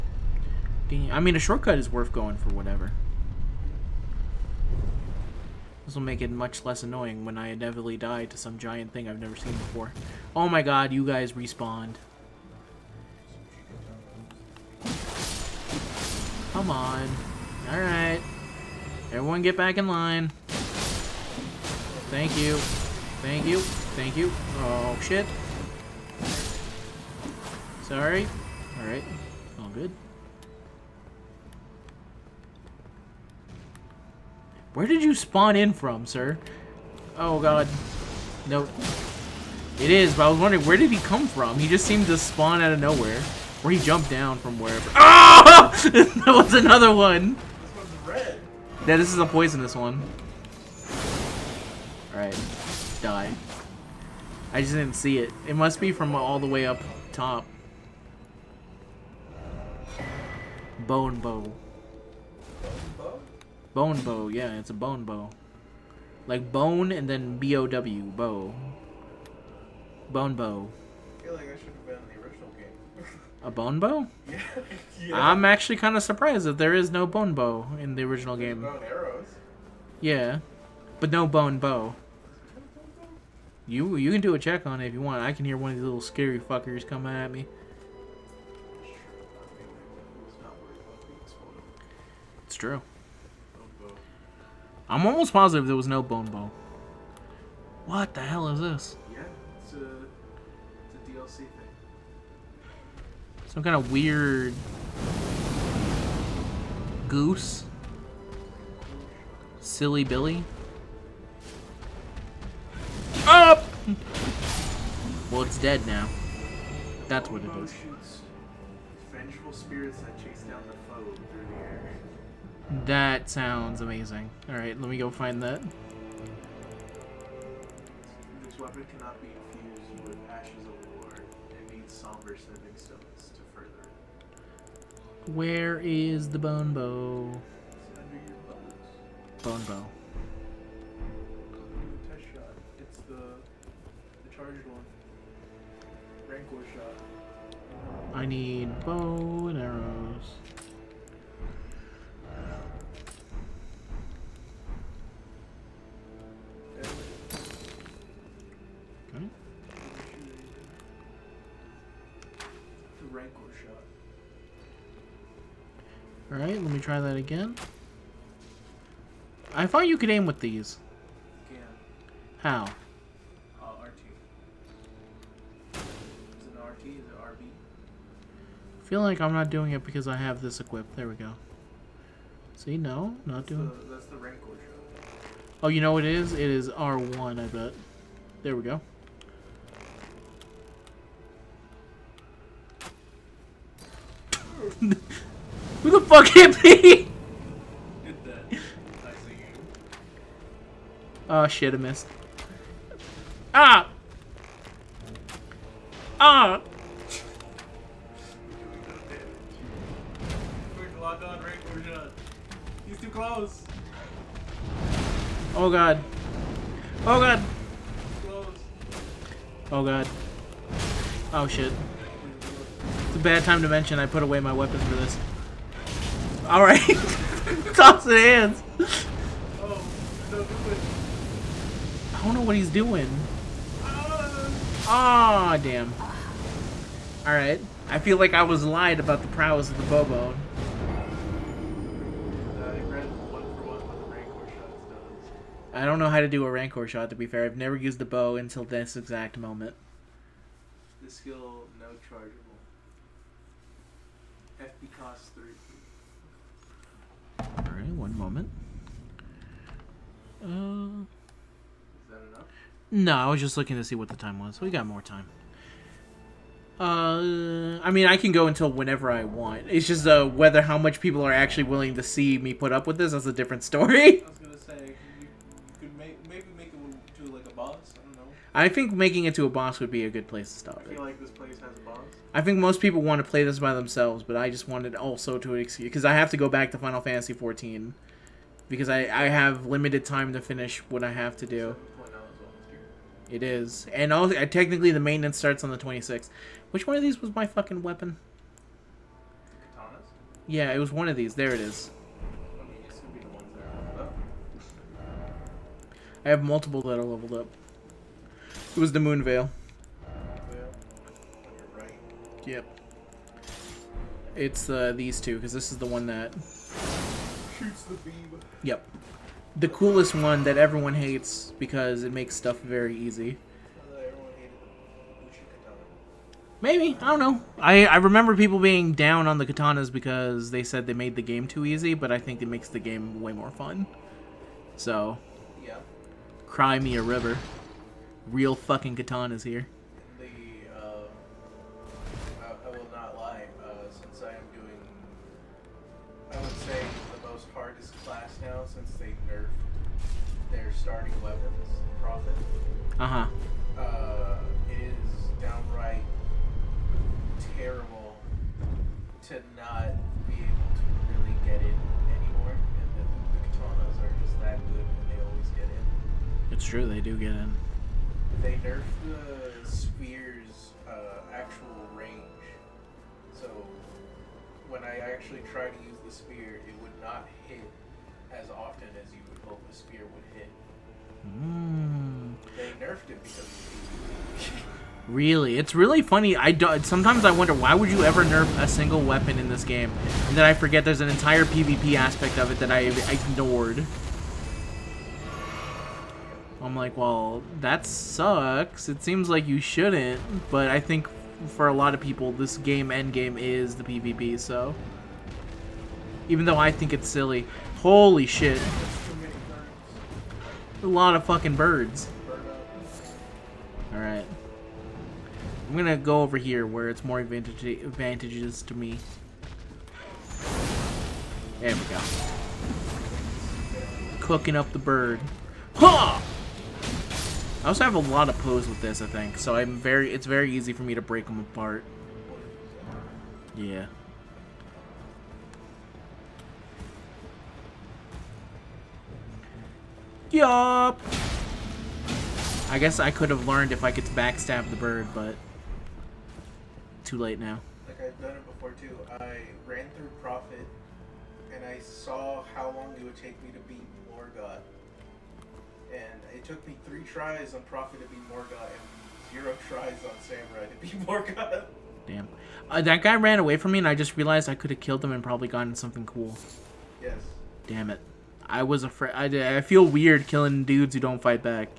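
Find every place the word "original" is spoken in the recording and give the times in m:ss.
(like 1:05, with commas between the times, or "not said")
1:12, 1:18.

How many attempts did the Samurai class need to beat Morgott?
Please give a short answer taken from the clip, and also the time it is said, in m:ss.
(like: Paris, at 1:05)
0, at 7:39.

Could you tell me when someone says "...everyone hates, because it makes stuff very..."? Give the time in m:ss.
5:20.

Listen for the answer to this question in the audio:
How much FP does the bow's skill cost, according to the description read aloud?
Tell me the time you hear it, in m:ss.
4:17.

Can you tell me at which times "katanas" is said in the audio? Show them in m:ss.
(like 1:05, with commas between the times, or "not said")
4:59, 5:29, 5:38, 6:03.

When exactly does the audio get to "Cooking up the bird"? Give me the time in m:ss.
7:04.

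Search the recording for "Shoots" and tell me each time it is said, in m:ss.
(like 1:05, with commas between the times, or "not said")
5:17.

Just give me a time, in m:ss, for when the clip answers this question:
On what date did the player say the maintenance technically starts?
4:55.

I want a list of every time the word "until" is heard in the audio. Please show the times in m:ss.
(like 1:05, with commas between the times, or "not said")
4:08, 4:28.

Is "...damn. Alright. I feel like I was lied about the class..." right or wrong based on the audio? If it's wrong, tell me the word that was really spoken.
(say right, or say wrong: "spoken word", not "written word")
wrong: "prowess", not "class".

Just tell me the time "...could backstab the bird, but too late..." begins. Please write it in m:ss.
7:23.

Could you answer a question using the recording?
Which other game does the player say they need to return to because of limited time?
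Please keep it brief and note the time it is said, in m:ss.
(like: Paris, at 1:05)
Final Fantasy XIV, at 4:46.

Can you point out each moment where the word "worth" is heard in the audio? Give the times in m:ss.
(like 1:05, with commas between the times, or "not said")
0:01.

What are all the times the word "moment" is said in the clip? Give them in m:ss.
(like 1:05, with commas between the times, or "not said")
4:09, 4:18.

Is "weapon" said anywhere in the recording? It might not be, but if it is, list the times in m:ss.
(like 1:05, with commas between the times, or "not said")
2:08, 3:44, 4:57, 5:51, 6:29.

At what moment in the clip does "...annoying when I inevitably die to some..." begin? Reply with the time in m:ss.
0:06.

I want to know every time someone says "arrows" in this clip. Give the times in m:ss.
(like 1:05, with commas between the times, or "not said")
1:18, 2:29.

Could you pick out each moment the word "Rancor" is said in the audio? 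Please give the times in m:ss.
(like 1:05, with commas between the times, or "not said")
3:04, 4:06.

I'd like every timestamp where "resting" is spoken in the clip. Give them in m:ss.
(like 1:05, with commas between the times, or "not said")
not said.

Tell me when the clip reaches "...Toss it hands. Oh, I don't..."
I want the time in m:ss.
3:47.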